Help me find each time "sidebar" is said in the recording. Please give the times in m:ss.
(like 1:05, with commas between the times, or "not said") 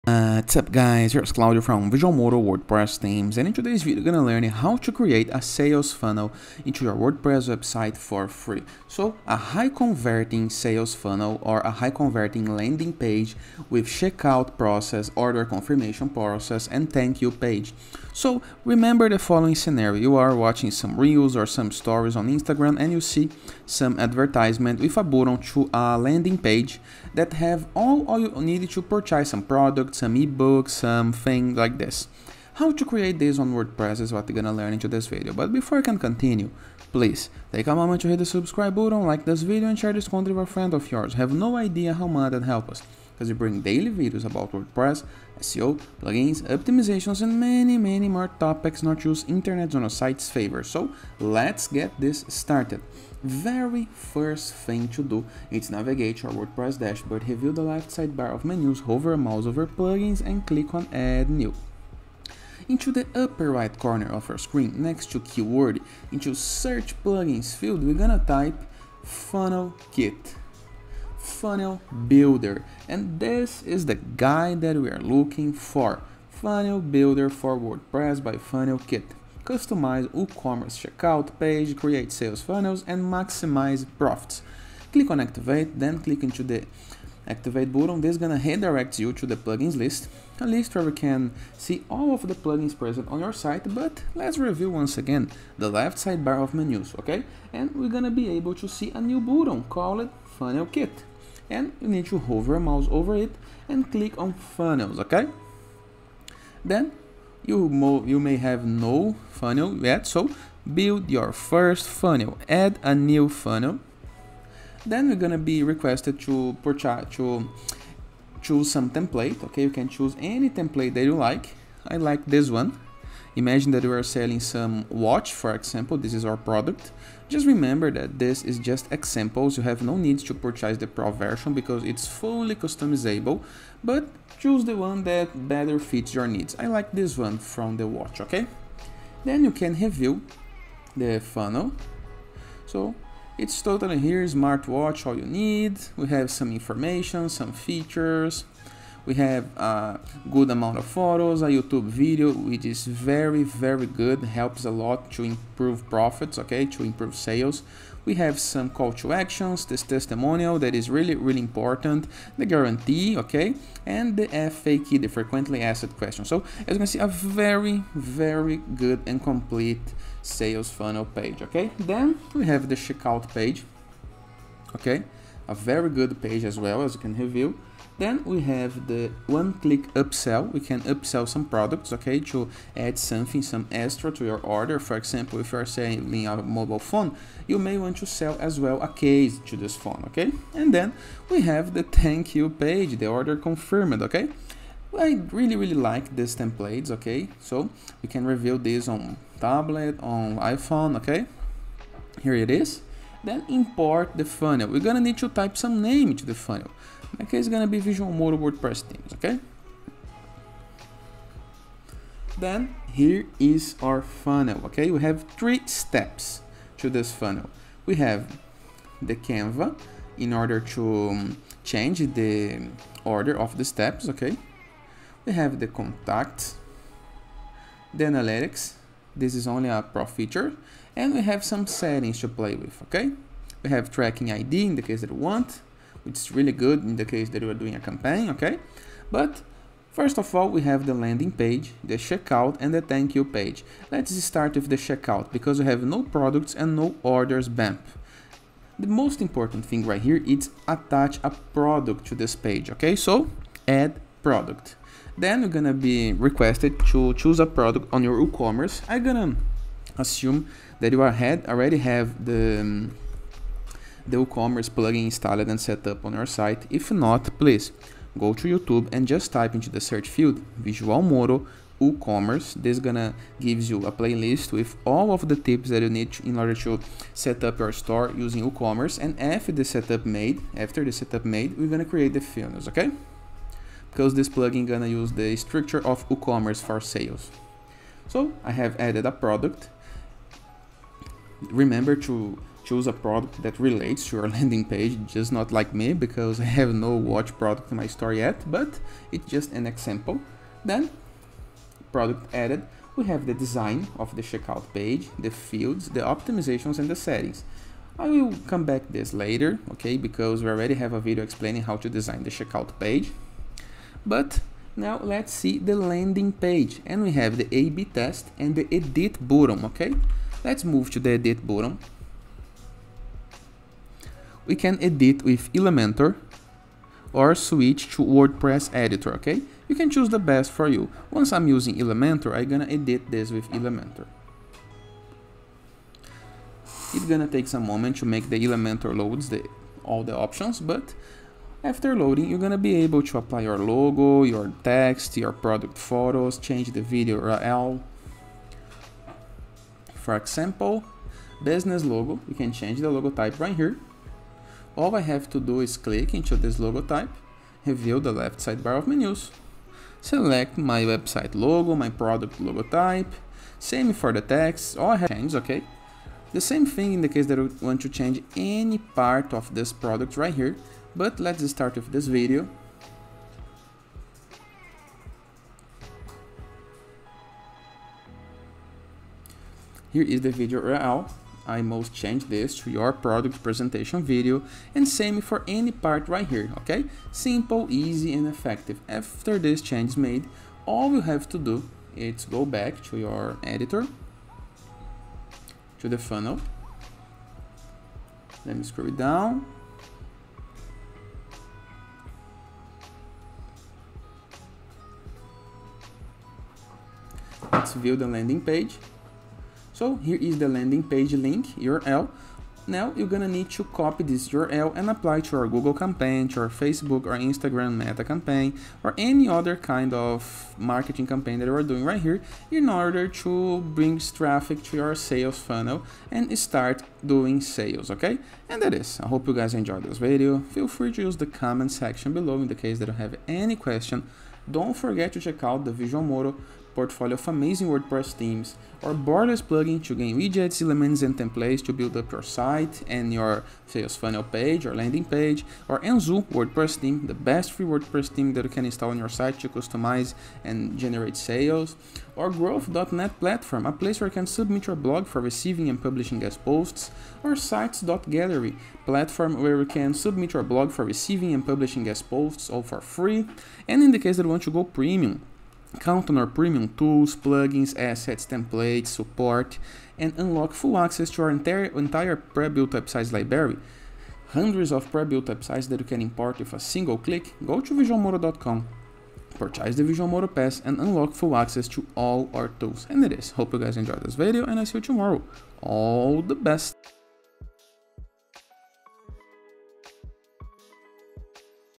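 0:57, 1:35, 5:58.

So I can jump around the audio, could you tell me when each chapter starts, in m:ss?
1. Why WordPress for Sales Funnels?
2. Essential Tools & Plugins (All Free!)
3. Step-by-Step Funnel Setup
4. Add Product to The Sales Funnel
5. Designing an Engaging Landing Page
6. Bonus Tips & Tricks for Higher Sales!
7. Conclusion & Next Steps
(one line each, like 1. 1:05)
1. 0:30
2. 1:00
3. 1:35
4. 3:30
5. 5:20
6. 6:40
7. 7:20.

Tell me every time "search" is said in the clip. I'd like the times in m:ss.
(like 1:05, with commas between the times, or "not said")
1:06, 4:29.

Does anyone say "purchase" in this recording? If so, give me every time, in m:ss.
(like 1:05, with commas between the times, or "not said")
0:28, 1:56, 2:10, 7:59.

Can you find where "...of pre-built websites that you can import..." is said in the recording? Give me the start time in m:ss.
7:54.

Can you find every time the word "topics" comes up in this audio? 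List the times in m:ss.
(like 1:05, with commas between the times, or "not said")
0:48.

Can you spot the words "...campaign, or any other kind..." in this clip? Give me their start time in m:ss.
6:58.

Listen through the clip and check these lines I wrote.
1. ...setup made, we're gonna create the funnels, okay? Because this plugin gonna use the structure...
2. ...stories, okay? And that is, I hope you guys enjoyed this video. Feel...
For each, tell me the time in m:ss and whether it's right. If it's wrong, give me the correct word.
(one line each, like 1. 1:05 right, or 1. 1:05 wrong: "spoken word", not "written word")
1. 4:40 right
2. 7:07 wrong: "sales", not "stories".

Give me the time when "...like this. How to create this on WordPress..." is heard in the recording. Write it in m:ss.
0:31.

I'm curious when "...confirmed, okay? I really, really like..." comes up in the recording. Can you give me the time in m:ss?
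3:13.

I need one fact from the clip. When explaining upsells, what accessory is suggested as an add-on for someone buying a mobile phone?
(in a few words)
a case.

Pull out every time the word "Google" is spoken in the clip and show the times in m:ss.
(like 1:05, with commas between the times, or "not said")
6:55.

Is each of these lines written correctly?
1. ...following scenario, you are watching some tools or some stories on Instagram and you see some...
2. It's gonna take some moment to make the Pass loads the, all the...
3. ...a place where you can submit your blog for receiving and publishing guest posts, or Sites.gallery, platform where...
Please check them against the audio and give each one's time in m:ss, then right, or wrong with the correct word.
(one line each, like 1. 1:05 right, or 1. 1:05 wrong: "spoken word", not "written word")
1. 0:19 wrong: "reels", not "tools"
2. 5:36 wrong: "Elementor", not "Pass"
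3. 7:33 right.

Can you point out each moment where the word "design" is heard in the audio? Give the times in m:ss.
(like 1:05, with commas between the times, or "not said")
5:03, 5:11.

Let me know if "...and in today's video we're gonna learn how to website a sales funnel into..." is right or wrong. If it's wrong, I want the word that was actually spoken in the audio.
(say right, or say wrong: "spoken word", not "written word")
wrong: "create", not "website".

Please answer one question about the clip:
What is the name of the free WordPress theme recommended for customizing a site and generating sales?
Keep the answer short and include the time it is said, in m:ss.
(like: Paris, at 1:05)
Enzu, at 7:25.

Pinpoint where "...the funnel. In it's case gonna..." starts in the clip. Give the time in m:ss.
3:26.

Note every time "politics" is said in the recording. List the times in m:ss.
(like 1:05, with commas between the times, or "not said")
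not said.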